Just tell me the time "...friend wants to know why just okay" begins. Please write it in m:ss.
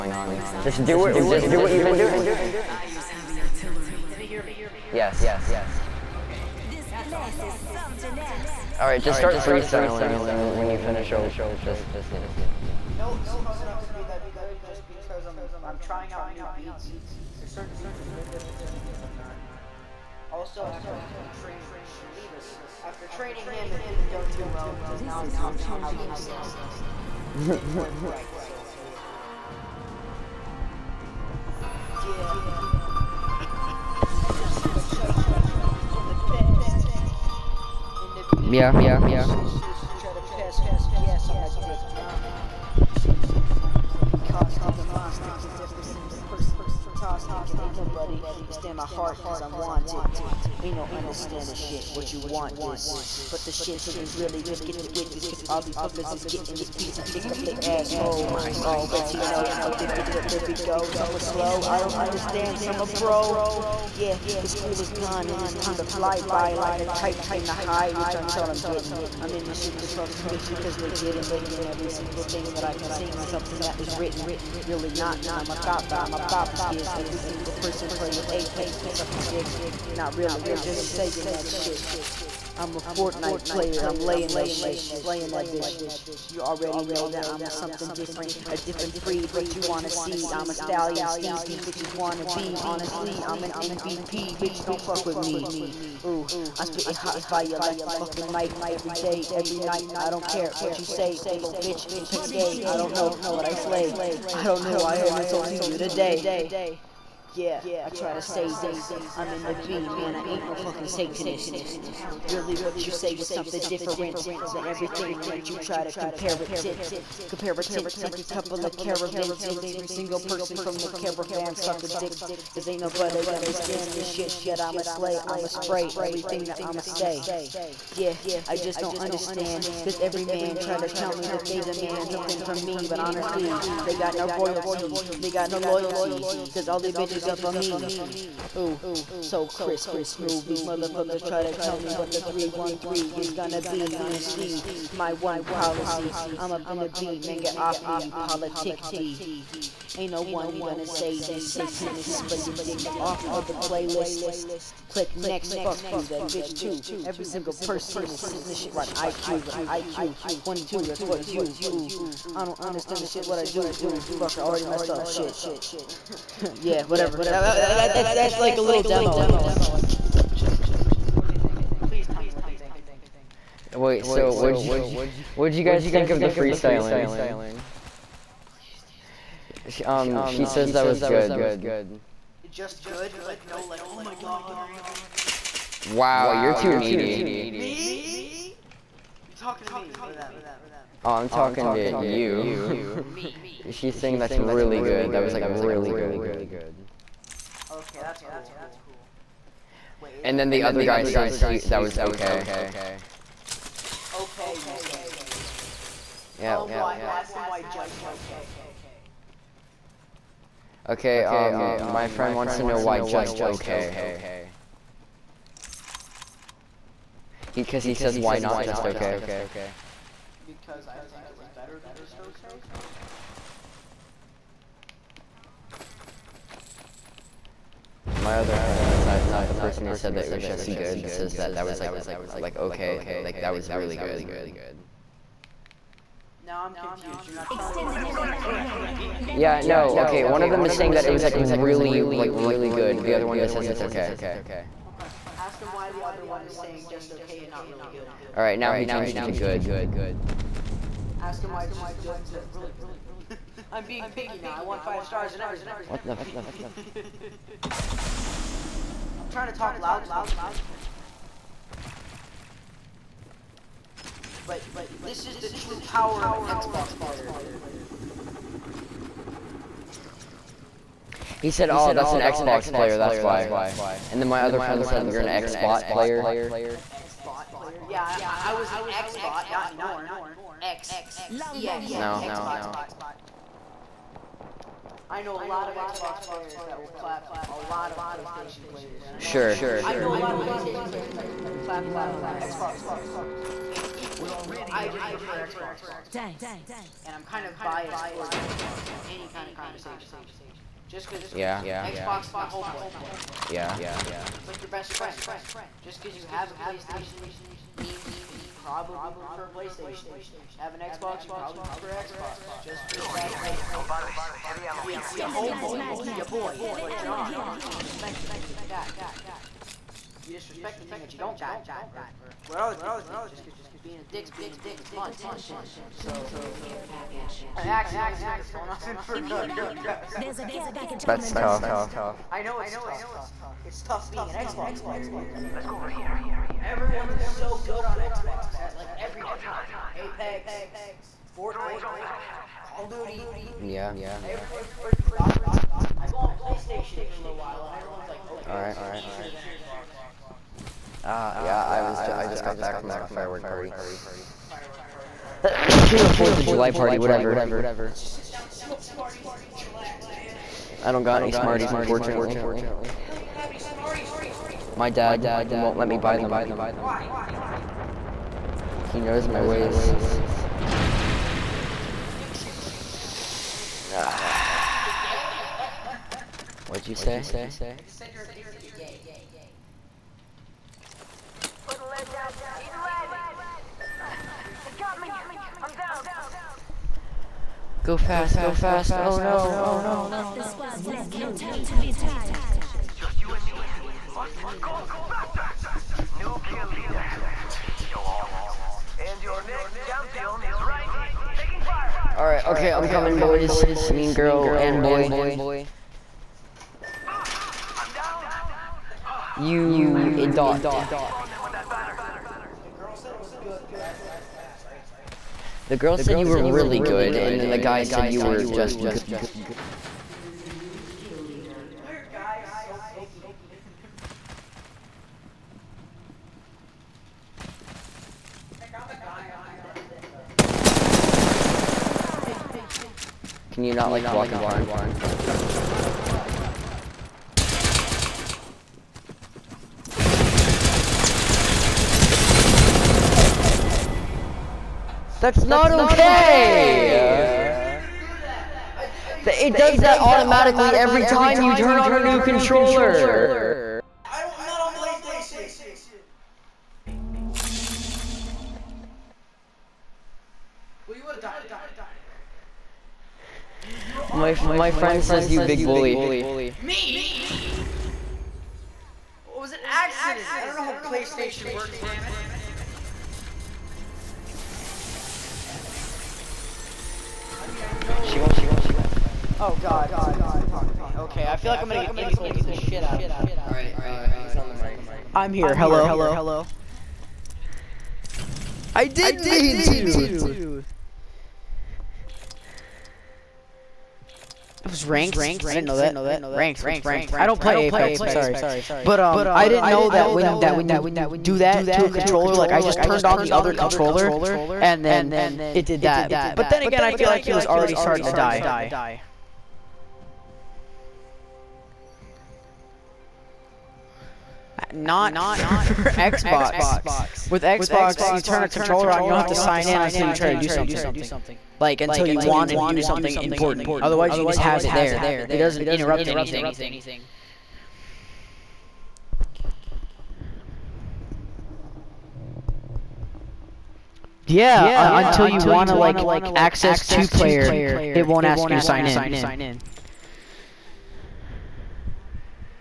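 3:32.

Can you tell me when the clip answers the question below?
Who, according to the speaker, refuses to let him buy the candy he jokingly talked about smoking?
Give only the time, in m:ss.
6:04.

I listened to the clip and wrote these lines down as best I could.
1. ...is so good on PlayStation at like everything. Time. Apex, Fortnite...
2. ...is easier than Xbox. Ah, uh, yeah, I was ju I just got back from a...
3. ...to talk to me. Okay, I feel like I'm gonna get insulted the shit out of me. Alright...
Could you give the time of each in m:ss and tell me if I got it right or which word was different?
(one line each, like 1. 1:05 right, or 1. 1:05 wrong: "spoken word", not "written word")
1. 5:37 wrong: "Xbox", not "PlayStation"
2. 5:49 right
3. 8:00 right.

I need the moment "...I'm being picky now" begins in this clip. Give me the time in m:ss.
4:13.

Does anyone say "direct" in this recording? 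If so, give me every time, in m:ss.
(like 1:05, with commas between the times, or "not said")
not said.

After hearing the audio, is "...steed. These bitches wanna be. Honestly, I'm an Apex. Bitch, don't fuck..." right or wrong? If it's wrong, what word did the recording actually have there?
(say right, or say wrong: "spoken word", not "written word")
wrong: "MVP", not "Apex".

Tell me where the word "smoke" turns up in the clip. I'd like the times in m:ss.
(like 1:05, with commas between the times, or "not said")
5:58.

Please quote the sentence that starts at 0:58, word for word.
Already know, addicted, there we go, some are slow, I don't understand, some are bro.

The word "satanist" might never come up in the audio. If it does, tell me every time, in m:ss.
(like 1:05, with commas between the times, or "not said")
1:50, 2:31.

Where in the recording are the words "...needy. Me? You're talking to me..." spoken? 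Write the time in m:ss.
3:06.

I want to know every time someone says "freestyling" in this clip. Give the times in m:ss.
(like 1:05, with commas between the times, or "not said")
0:09, 2:56.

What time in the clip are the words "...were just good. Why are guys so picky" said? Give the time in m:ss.
6:58.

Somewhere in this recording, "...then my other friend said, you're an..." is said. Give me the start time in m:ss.
4:34.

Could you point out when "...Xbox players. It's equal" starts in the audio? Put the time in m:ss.
4:52.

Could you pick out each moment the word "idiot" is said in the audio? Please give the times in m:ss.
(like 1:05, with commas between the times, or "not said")
6:50.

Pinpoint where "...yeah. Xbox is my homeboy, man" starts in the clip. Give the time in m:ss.
5:01.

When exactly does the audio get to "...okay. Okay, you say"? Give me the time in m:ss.
3:21.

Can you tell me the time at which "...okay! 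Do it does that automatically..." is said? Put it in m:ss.
7:25.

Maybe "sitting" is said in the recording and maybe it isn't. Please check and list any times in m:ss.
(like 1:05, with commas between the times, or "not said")
2:38.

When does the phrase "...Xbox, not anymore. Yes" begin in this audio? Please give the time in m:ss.
4:38.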